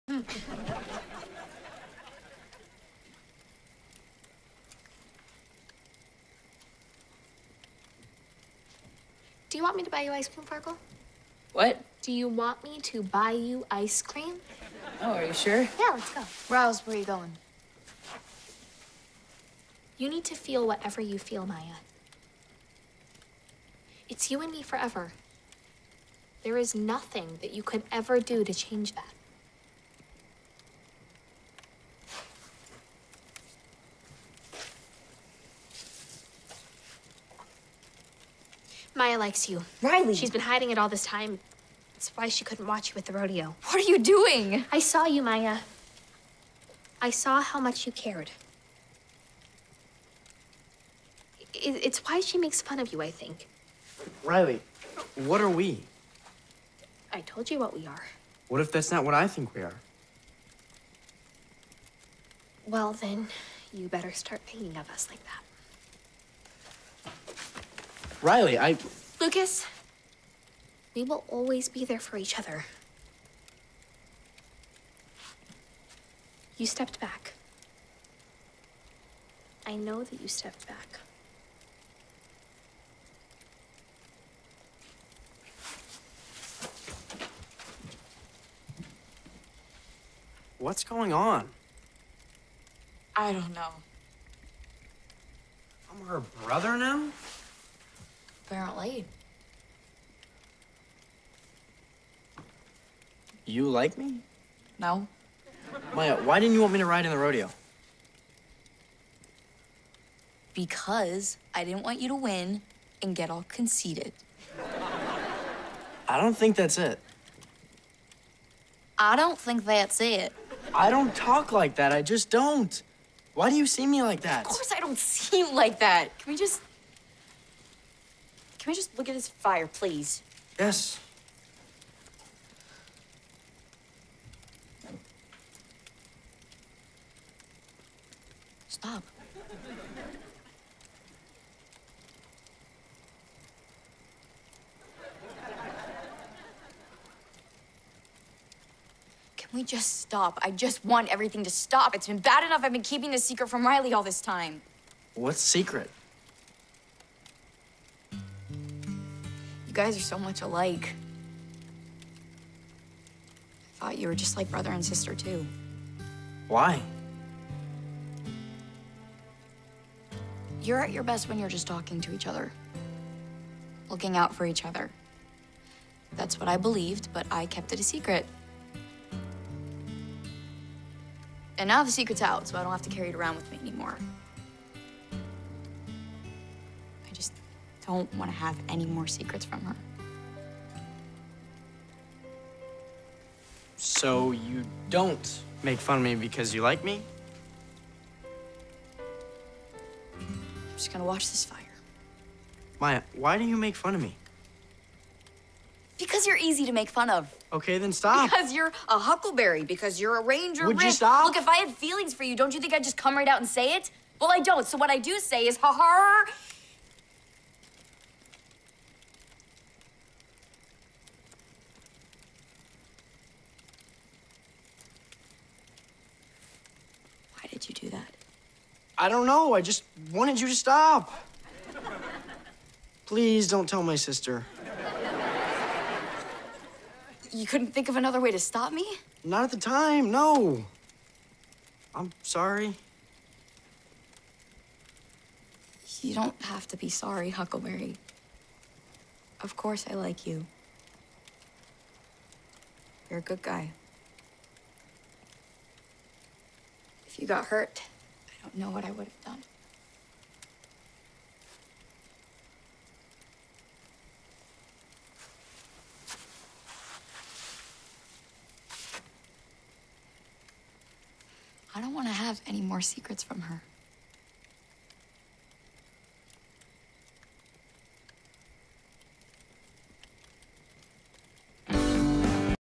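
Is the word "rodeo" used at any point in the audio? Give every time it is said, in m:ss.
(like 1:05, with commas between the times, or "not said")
0:43, 1:47.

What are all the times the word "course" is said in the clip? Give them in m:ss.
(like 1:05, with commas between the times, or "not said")
2:04, 4:09.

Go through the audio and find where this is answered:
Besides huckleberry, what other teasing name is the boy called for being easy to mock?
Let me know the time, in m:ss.
3:30.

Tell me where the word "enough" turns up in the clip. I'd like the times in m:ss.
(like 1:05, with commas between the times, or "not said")
2:32.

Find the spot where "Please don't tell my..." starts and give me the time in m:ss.
3:53.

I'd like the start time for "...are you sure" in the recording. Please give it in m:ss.
0:15.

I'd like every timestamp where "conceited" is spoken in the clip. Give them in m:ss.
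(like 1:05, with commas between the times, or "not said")
1:53.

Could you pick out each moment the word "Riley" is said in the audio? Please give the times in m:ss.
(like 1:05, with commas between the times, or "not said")
0:39, 0:54, 1:08, 2:33.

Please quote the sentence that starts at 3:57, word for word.
You couldn't think of another way to stop me?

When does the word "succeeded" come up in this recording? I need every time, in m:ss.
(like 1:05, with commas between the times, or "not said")
not said.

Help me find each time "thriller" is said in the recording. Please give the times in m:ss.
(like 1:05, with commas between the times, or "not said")
not said.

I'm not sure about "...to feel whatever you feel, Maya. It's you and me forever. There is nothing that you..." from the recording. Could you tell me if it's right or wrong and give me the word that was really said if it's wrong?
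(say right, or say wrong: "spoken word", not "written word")
right.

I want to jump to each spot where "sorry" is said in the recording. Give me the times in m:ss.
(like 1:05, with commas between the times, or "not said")
4:02, 4:06.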